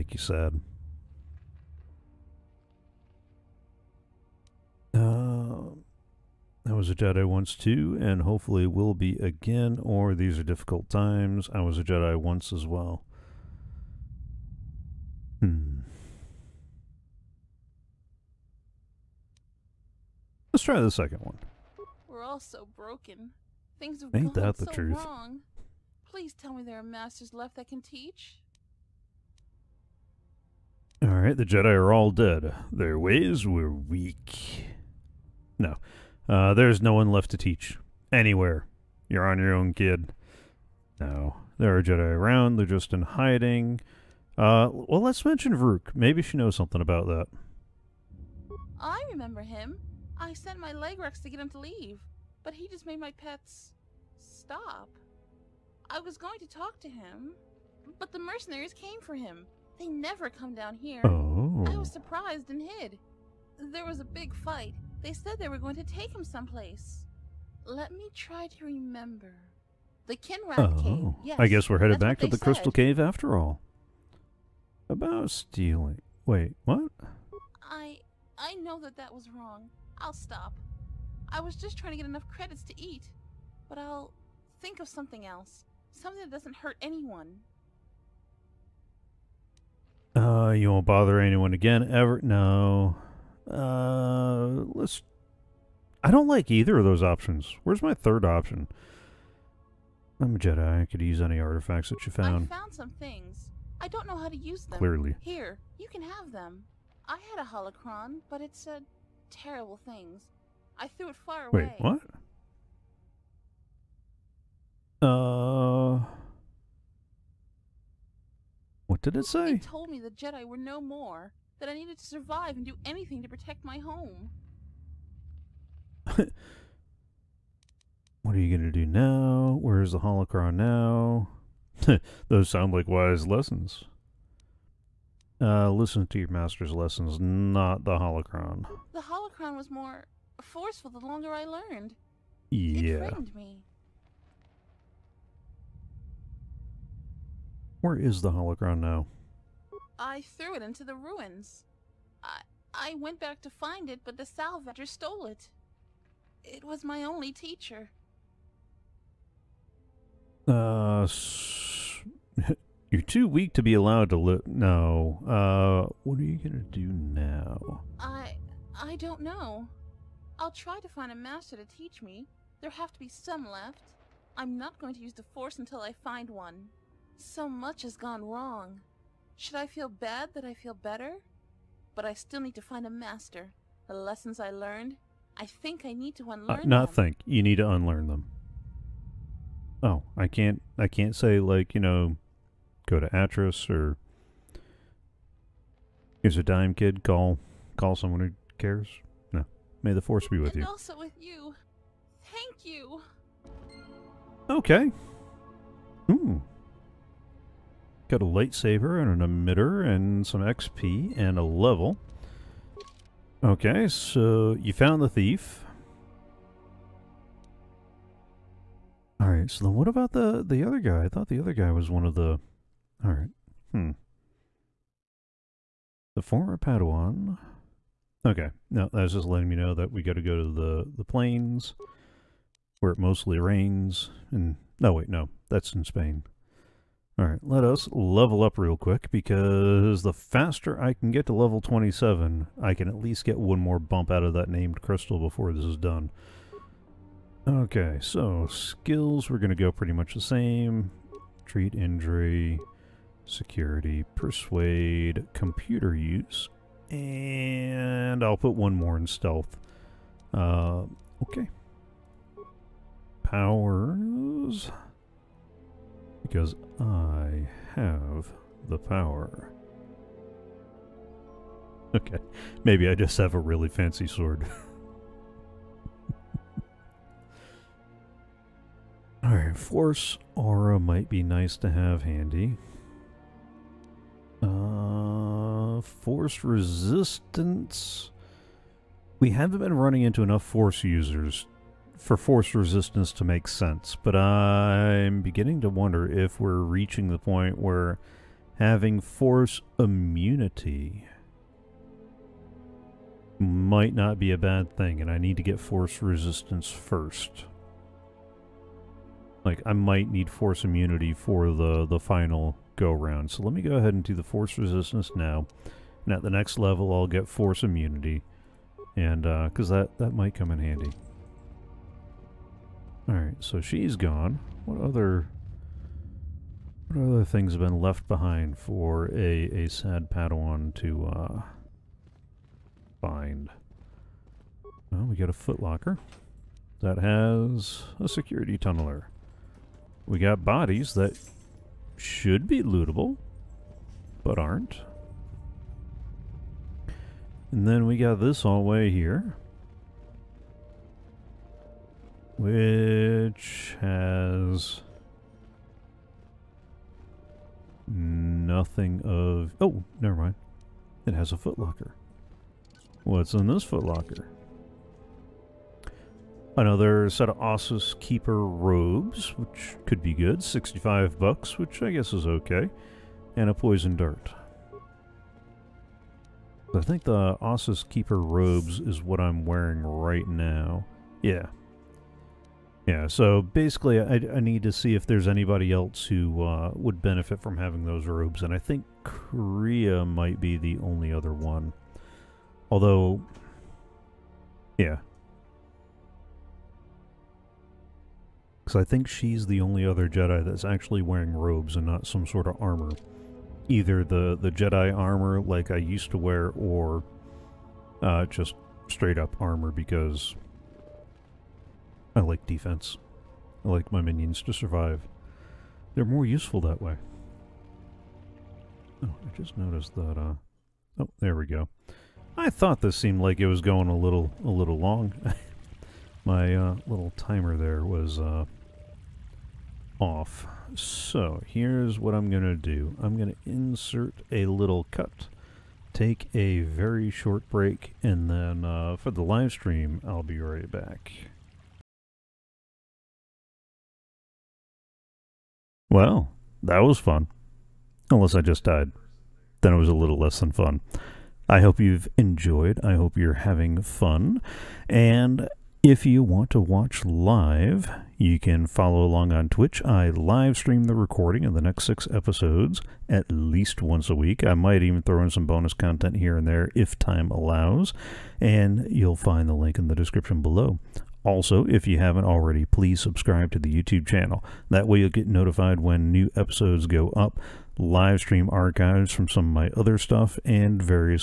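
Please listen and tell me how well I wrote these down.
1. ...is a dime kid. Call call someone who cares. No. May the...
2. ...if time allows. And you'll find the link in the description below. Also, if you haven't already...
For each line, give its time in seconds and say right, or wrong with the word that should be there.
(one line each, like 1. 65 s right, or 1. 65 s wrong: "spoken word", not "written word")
1. 196 s right
2. 466 s right.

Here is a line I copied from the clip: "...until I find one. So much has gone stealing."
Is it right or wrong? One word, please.
wrong.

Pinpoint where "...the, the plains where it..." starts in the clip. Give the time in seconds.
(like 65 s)
230 s.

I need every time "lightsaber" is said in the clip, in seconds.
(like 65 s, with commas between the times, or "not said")
208 s.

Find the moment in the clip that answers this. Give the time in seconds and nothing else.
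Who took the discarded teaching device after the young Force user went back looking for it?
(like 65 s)
154 s.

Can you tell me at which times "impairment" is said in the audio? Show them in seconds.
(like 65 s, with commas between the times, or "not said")
not said.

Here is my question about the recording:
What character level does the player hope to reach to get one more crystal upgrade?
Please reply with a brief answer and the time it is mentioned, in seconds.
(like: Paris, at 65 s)
27, at 241 s.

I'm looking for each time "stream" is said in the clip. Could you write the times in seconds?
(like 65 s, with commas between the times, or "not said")
439 s, 460 s, 478 s.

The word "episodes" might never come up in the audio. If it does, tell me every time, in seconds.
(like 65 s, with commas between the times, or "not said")
462 s, 476 s.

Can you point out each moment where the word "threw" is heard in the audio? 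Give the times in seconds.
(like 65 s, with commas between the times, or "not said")
110 s, 150 s.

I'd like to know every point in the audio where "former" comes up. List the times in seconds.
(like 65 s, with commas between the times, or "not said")
226 s.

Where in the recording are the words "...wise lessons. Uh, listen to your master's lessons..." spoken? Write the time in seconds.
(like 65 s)
132 s.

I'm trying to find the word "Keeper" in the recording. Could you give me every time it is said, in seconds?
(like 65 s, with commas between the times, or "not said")
367 s, 377 s.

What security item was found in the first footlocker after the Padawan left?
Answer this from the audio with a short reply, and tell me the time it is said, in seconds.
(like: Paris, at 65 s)
Security tunneler, at 338 s.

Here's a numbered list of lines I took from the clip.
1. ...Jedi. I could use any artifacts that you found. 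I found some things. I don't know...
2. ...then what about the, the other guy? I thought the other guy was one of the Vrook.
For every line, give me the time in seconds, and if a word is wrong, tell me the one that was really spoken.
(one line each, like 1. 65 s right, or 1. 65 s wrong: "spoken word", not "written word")
1. 100 s right
2. 219 s wrong: "Alright", not "Vrook".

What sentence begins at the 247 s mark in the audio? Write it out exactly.
Okay, so skills, we're going to go pretty much the same.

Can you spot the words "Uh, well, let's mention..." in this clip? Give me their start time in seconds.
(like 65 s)
44 s.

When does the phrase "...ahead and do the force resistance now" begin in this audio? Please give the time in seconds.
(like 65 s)
313 s.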